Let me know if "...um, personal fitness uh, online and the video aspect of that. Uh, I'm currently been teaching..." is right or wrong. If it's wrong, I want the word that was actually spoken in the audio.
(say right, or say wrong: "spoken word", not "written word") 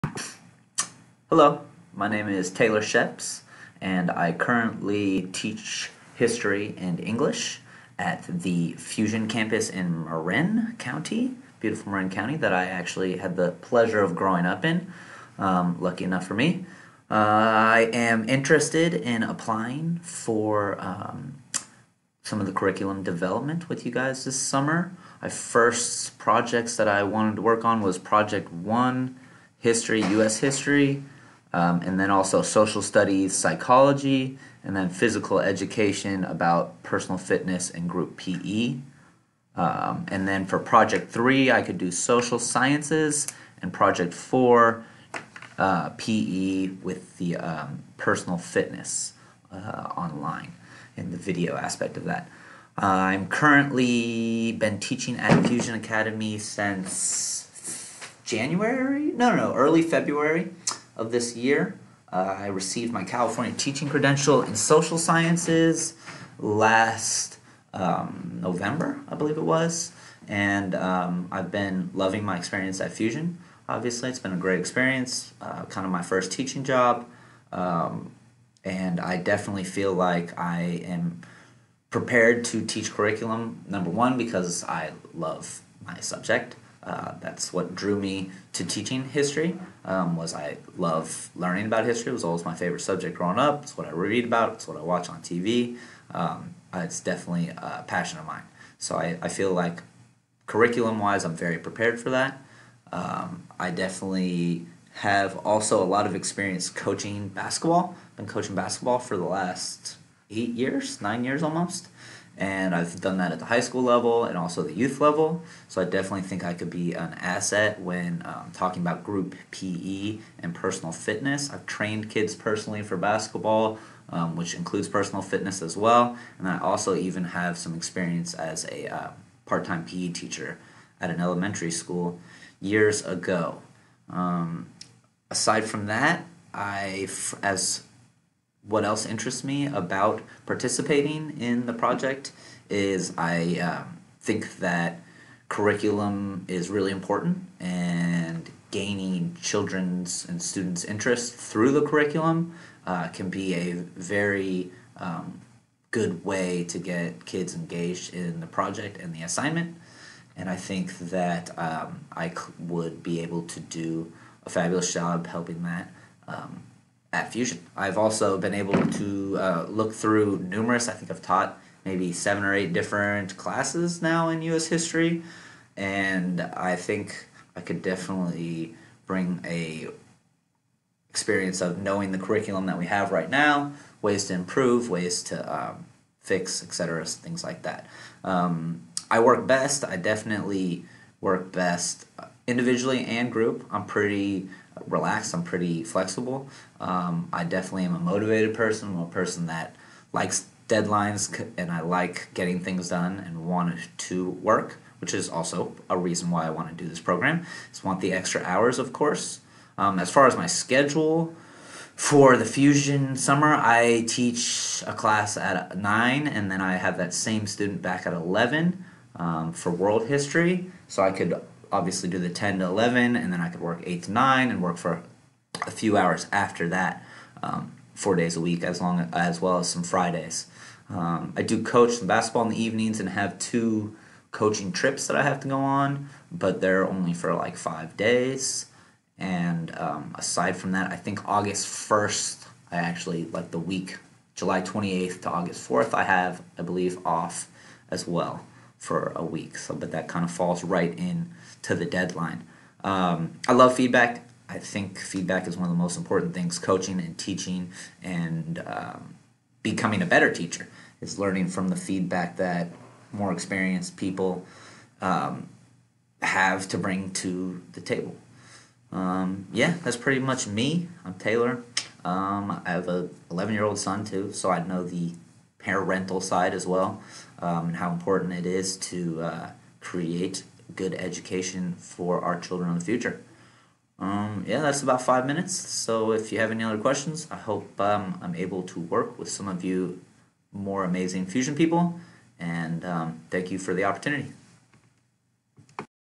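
right.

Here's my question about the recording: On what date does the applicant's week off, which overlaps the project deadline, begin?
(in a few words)
July 28th.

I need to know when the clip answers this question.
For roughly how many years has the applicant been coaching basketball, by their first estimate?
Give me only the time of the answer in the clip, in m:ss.
1:50.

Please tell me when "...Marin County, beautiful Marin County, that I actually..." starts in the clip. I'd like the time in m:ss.
0:10.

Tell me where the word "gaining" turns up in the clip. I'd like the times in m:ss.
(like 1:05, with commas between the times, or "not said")
2:28.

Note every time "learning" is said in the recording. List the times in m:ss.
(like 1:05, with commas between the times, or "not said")
1:31, 4:21.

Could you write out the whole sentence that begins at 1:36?
Um, uh, it's definitely a passion of mine.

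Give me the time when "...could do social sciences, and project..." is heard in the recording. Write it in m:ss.
0:41.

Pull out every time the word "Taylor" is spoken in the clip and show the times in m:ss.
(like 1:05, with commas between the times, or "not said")
0:02, 4:31.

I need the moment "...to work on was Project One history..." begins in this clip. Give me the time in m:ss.
0:27.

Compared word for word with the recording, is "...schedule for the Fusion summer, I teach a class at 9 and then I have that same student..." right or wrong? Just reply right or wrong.
right.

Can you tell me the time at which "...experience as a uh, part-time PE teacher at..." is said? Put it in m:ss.
2:07.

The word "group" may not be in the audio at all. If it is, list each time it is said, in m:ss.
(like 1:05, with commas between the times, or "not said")
0:37, 1:59, 3:13.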